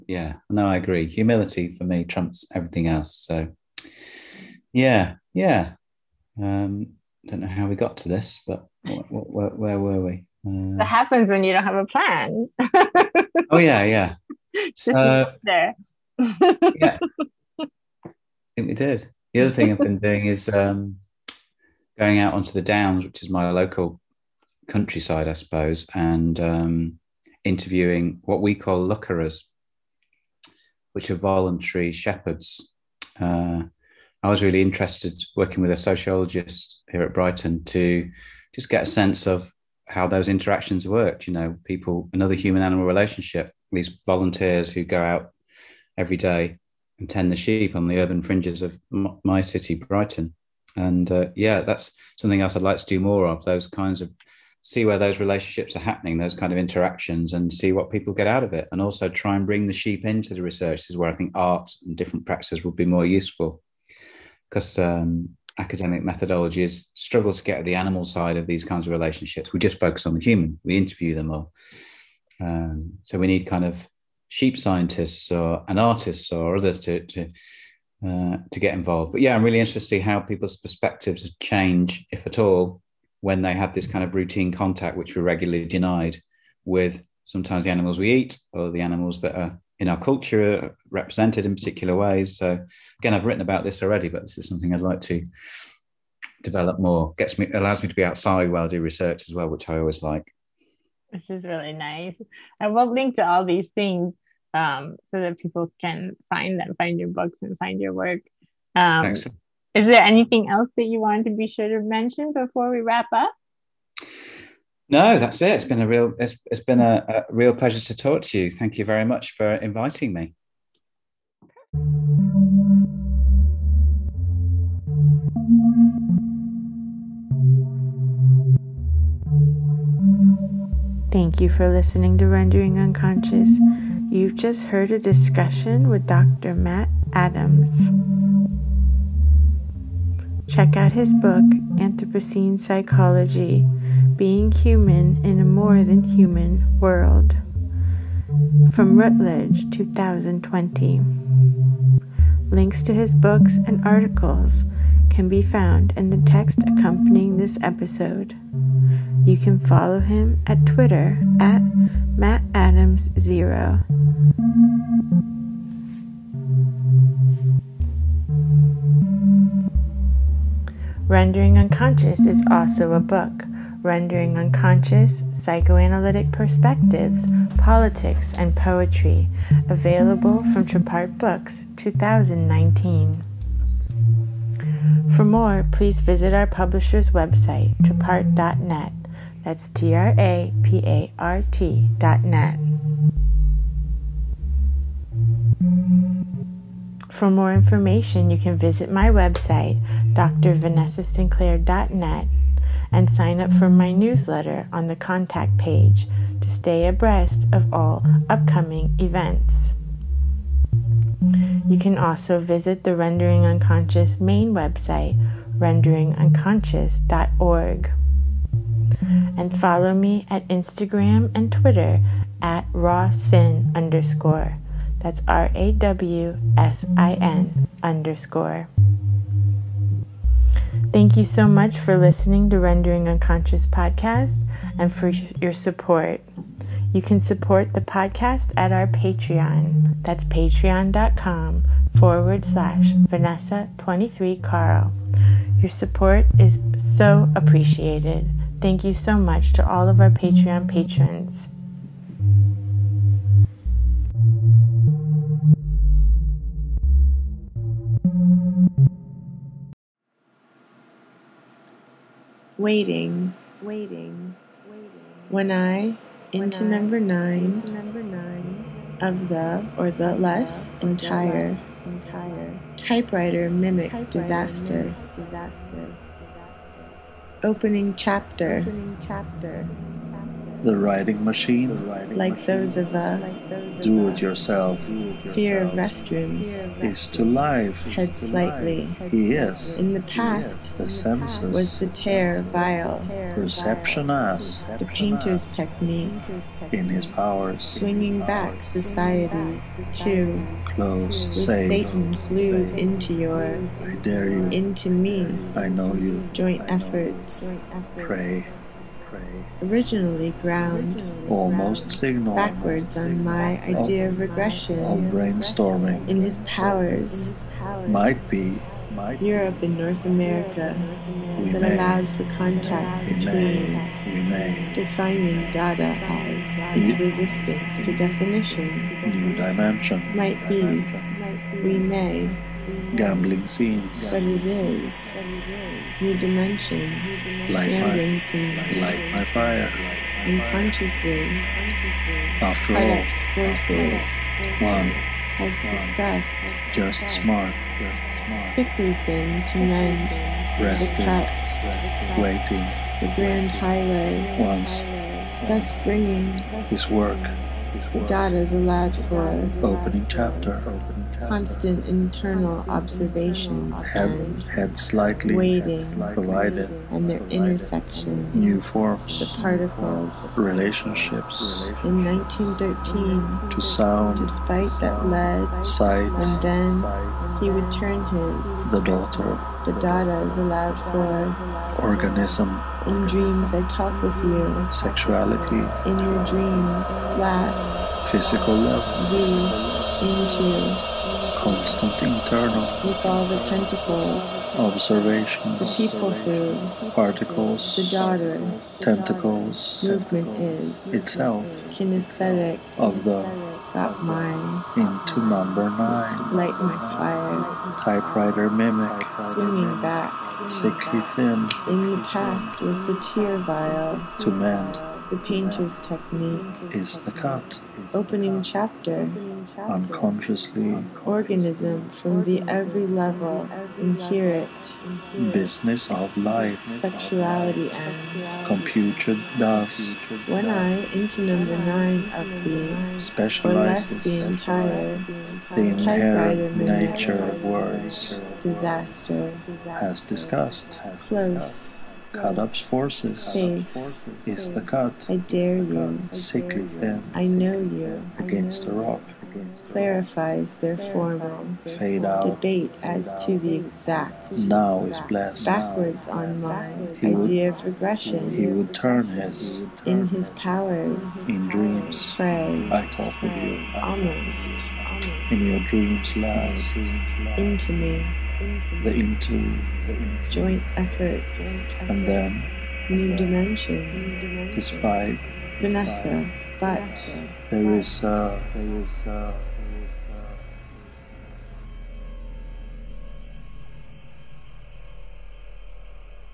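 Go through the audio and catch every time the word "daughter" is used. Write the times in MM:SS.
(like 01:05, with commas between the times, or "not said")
06:18, 06:37.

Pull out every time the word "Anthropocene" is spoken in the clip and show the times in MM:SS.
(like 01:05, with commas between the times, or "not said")
02:21.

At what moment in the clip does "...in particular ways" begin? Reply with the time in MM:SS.
01:31.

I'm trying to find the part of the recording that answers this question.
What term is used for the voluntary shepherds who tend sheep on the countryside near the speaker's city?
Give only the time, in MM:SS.
00:28.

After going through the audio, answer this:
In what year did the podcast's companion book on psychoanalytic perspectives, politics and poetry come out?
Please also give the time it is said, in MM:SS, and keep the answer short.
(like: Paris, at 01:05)
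2019, at 03:01.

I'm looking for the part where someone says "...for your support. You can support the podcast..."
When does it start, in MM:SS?
03:54.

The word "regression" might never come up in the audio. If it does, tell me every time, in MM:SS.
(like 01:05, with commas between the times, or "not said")
05:14, 07:37.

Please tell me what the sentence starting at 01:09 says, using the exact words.
We just focus on the human, we interview them all.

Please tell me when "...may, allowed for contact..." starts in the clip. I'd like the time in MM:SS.
05:21.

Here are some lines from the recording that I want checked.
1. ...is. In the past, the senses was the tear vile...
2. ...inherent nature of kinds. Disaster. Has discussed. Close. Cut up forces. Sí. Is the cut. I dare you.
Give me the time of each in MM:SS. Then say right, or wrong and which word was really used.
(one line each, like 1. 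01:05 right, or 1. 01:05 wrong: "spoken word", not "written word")
1. 04:49 right
2. 07:15 wrong: "words", not "kinds".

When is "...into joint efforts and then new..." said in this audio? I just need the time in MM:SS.
07:48.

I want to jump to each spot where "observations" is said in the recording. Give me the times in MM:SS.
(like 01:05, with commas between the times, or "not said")
06:02, 06:34.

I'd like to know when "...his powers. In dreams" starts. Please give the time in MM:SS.
07:40.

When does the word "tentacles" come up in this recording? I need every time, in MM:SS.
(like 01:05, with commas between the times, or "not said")
06:33, 06:38.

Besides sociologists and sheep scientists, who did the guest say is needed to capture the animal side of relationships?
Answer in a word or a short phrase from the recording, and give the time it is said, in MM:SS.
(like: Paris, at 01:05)
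artists, at 01:15.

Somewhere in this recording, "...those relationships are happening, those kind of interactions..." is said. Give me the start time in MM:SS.
00:54.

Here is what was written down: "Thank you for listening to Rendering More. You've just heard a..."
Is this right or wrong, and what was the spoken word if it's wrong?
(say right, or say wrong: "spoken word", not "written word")
wrong: "Unconscious", not "More".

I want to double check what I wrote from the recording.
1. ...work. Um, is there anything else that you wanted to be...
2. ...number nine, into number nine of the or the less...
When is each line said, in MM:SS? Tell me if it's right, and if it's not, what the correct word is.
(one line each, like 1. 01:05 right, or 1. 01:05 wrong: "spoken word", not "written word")
1. 01:47 right
2. 04:26 right.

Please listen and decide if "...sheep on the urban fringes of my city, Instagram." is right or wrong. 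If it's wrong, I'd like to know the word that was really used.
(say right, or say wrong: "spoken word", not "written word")
wrong: "Brighton", not "Instagram".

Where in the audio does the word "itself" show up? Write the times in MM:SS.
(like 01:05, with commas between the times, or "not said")
06:40.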